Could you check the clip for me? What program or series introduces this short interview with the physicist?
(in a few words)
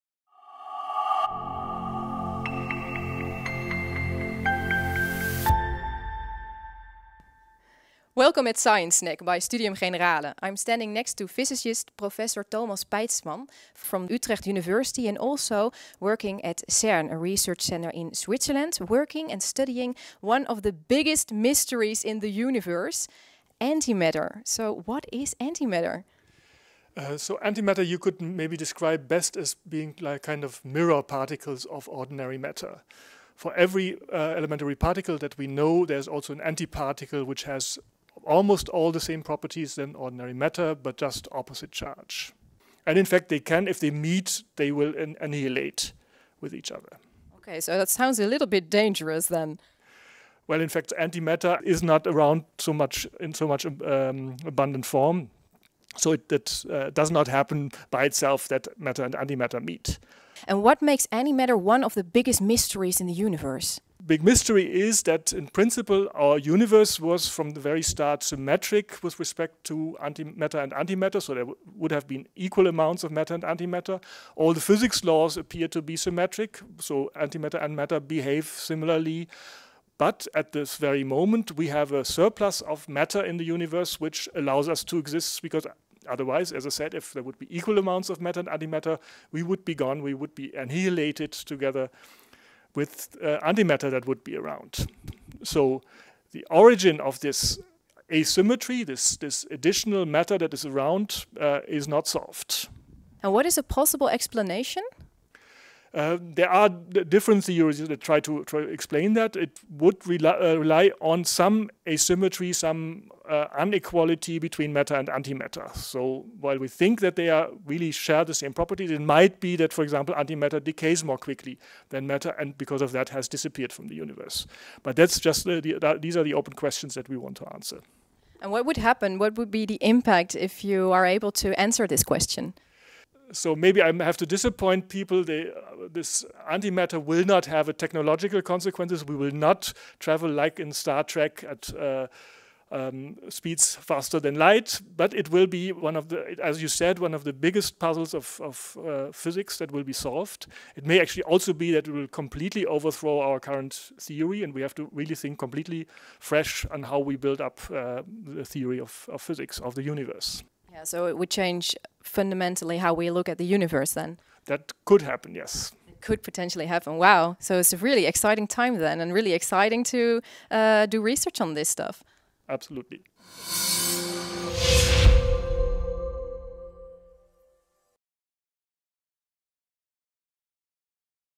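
Science Snack.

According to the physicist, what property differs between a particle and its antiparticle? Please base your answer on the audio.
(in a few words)
Opposite charge.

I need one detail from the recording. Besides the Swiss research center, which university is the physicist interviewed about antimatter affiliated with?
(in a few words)
Utrecht University.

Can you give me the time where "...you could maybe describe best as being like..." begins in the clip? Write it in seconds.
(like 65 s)
27 s.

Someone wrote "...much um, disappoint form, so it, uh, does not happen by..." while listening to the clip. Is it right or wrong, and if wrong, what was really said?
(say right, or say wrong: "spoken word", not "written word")
wrong: "abundant", not "disappoint".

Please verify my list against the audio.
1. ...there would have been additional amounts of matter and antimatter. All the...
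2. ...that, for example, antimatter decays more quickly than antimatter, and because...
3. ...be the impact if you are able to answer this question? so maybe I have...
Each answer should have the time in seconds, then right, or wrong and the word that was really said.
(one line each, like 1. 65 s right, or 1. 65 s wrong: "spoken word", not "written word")
1. 71 s wrong: "equal", not "additional"
2. 119 s wrong: "matter", not "antimatter"
3. 129 s right.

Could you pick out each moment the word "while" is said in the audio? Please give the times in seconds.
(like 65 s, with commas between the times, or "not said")
116 s.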